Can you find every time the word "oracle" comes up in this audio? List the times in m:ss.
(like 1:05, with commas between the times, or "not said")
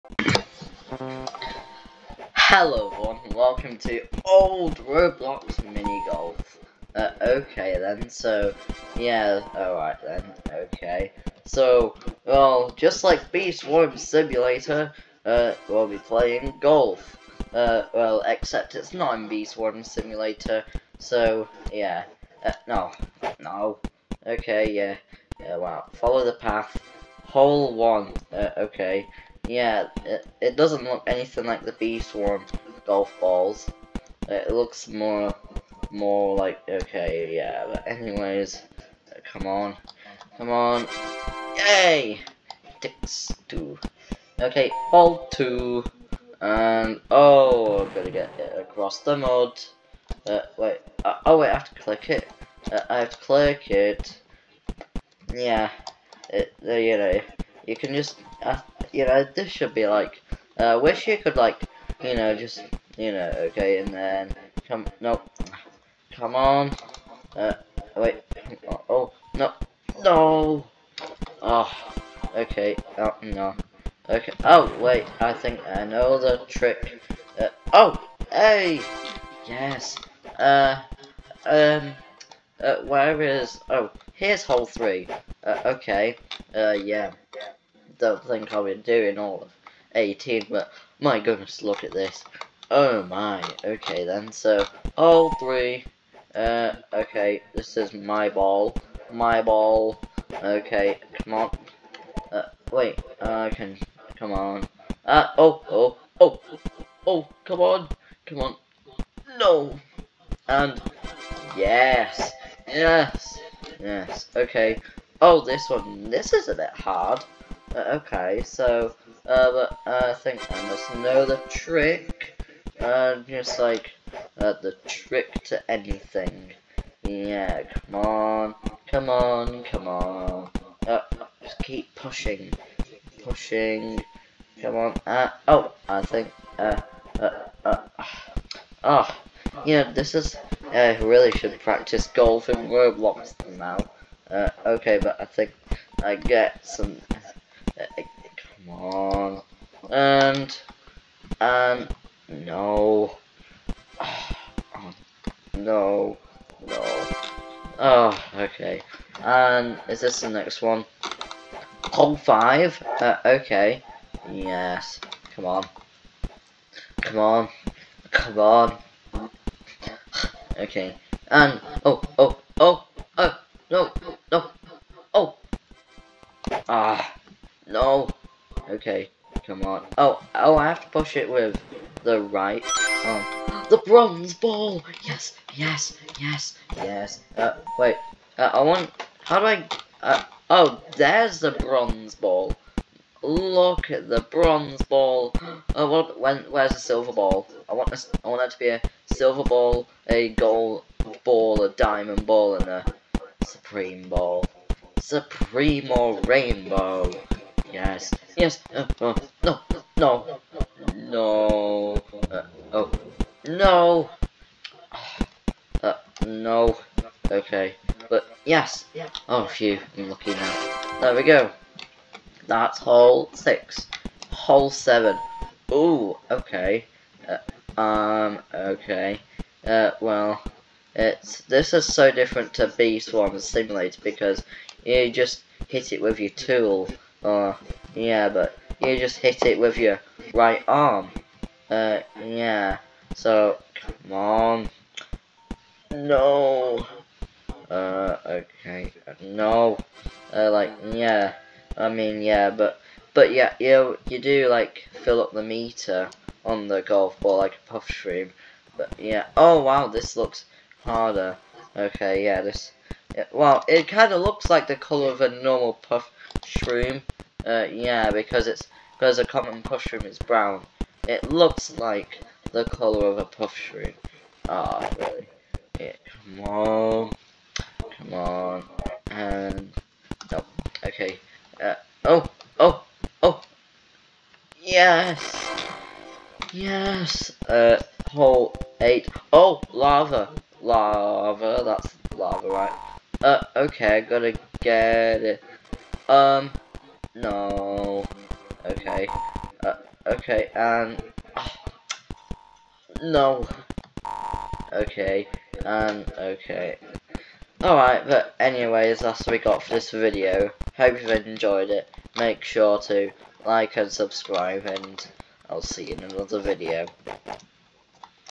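not said.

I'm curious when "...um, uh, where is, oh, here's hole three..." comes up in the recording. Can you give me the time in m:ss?
1:21.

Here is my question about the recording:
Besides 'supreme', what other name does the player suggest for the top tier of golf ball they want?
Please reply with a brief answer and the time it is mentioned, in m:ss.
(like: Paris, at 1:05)
Rainbow, at 3:26.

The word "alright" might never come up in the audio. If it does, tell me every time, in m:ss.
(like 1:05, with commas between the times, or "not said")
0:09, 5:07.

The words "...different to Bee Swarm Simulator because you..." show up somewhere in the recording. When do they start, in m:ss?
3:52.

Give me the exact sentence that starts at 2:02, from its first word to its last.
Uh, just like, uh, the trick to anything.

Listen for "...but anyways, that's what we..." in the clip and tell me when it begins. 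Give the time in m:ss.
5:08.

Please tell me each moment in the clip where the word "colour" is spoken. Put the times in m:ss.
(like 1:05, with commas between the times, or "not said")
4:24, 4:32.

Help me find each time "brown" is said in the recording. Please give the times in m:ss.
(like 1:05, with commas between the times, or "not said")
4:30.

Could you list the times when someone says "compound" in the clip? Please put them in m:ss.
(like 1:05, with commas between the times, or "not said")
not said.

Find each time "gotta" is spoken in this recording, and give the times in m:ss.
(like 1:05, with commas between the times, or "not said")
4:54.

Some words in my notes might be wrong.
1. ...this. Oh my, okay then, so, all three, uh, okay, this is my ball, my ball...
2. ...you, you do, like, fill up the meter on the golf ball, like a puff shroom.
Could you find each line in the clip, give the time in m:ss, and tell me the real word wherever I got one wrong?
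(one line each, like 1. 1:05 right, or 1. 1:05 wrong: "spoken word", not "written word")
1. 1:31 right
2. 4:13 right.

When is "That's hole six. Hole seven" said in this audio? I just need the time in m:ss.
3:42.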